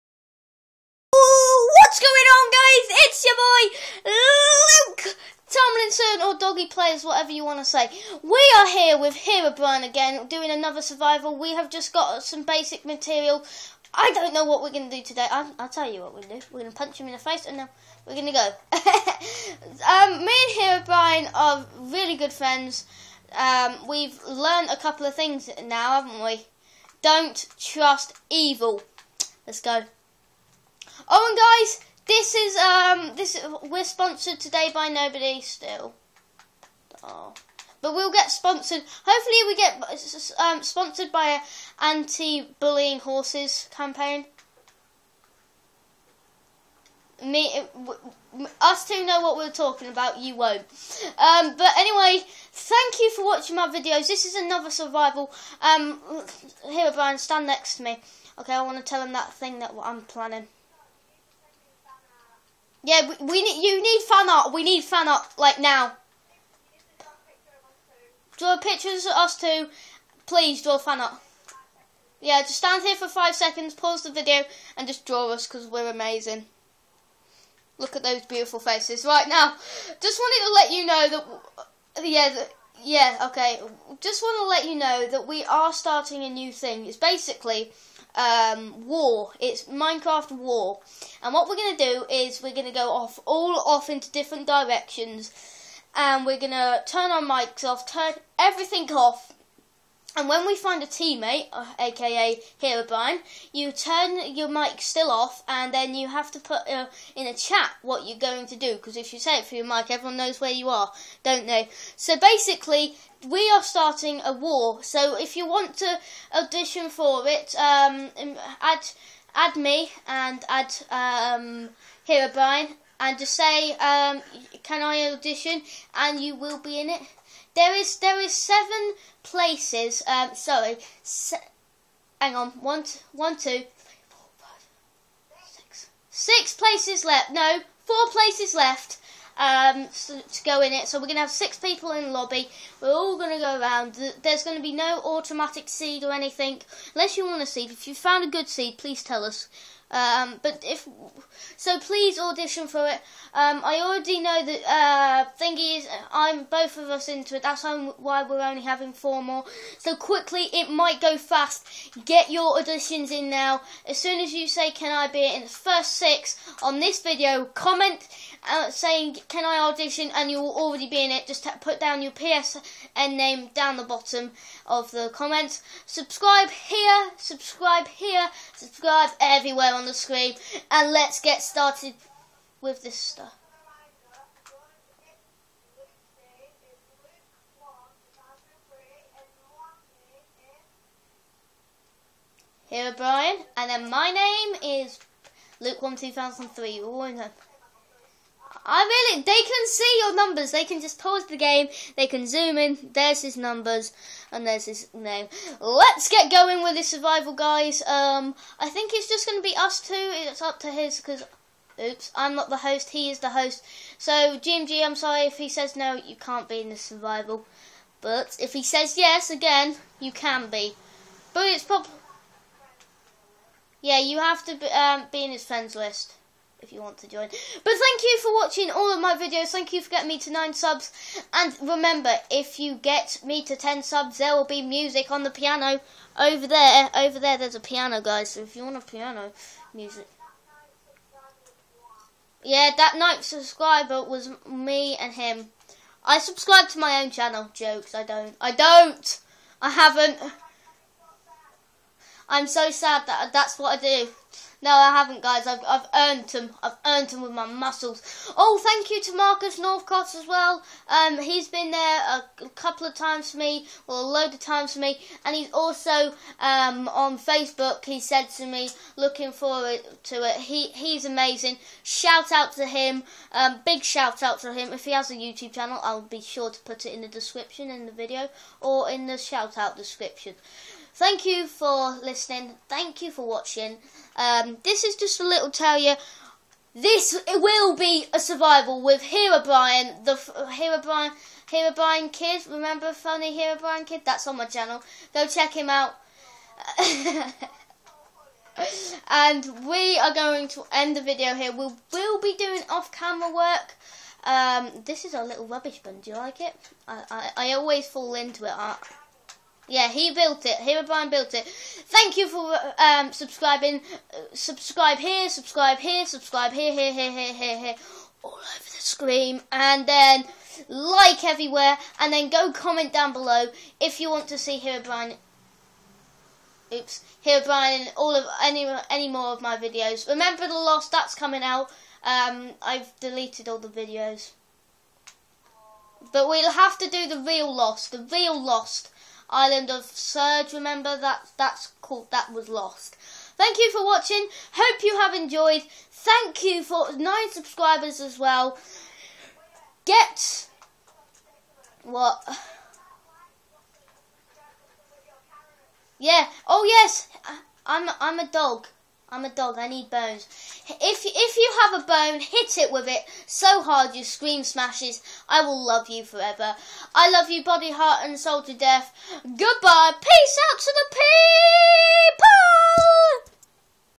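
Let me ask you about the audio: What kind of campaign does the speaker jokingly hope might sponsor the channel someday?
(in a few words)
anti-bullying horses campaign.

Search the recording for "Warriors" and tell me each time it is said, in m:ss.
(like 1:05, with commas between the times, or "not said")
not said.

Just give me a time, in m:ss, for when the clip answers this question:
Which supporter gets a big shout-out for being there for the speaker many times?
4:19.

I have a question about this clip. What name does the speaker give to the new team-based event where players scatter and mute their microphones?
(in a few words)
Minecraft War.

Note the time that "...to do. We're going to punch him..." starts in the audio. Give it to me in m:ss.
0:16.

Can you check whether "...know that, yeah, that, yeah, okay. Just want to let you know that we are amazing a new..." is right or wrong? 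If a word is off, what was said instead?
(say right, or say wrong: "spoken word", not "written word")
wrong: "starting", not "amazing".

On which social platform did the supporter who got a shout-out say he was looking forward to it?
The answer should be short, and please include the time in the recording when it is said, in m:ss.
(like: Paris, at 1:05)
Facebook, at 4:27.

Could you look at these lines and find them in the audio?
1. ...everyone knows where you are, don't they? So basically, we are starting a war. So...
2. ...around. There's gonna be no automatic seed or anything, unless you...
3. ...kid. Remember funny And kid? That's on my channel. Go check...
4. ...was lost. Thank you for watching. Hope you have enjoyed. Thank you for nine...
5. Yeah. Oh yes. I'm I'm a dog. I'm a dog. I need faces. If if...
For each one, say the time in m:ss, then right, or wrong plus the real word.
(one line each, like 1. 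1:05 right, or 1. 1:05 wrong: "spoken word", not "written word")
1. 1:49 right
2. 2:23 right
3. 4:52 wrong: "Herobrine", not "And"
4. 5:42 right
5. 5:55 wrong: "bones", not "faces".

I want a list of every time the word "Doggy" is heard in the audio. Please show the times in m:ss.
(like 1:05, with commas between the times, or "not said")
0:06.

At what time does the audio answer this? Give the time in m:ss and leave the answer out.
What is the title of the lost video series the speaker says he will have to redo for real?
5:39.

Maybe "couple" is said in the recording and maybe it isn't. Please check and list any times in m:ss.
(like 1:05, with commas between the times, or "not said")
0:24, 4:22.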